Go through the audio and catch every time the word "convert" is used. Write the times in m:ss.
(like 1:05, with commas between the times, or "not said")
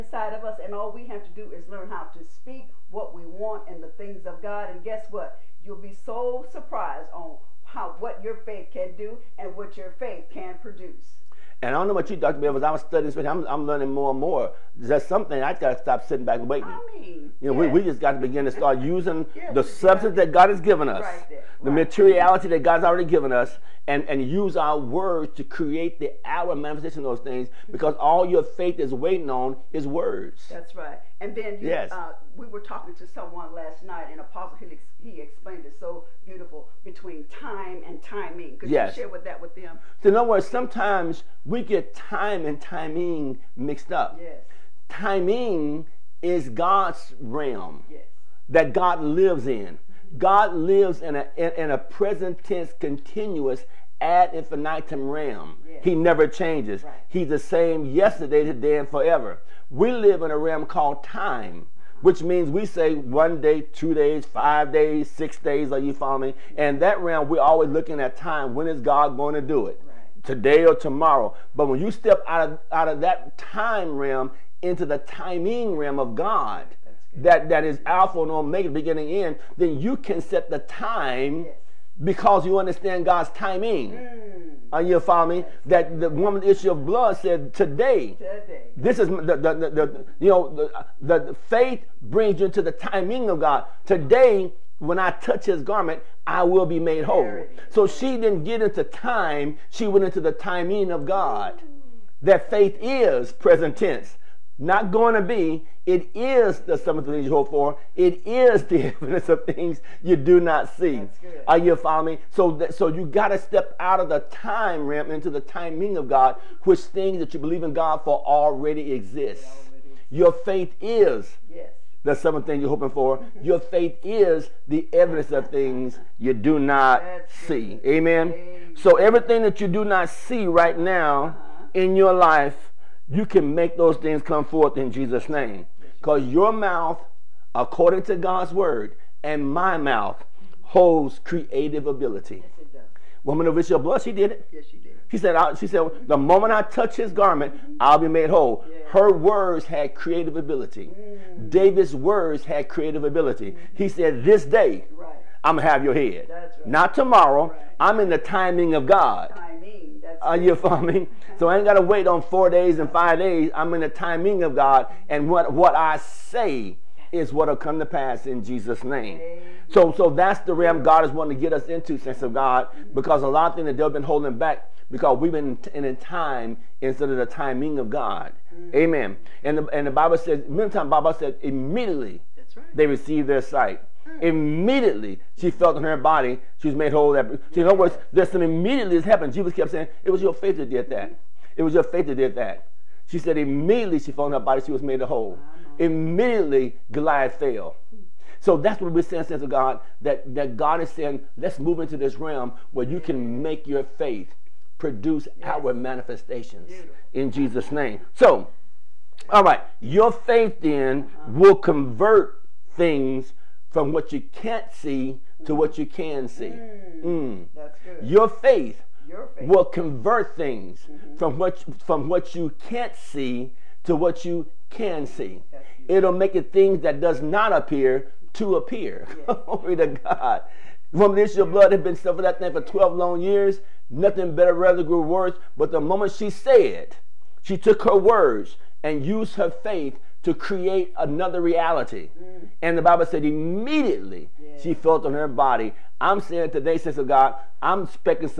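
3:31, 3:39.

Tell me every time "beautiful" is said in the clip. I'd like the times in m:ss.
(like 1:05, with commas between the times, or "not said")
0:36, 3:26.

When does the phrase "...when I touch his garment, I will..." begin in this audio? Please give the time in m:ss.
1:34.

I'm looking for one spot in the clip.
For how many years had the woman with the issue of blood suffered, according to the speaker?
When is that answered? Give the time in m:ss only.
3:52.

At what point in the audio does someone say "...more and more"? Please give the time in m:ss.
0:13.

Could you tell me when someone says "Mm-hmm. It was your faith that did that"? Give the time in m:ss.
3:11.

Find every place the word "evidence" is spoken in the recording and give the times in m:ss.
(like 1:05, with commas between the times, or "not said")
1:48, 2:04.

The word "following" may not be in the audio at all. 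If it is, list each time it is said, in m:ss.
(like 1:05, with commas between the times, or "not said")
1:05, 1:25, 1:51, 2:40.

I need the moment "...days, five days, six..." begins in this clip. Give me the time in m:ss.
1:03.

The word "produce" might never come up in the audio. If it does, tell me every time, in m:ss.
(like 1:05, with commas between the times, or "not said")
0:10, 3:24.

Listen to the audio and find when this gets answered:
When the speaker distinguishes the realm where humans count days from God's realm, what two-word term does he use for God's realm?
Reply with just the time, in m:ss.
1:14.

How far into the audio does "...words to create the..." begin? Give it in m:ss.
0:24.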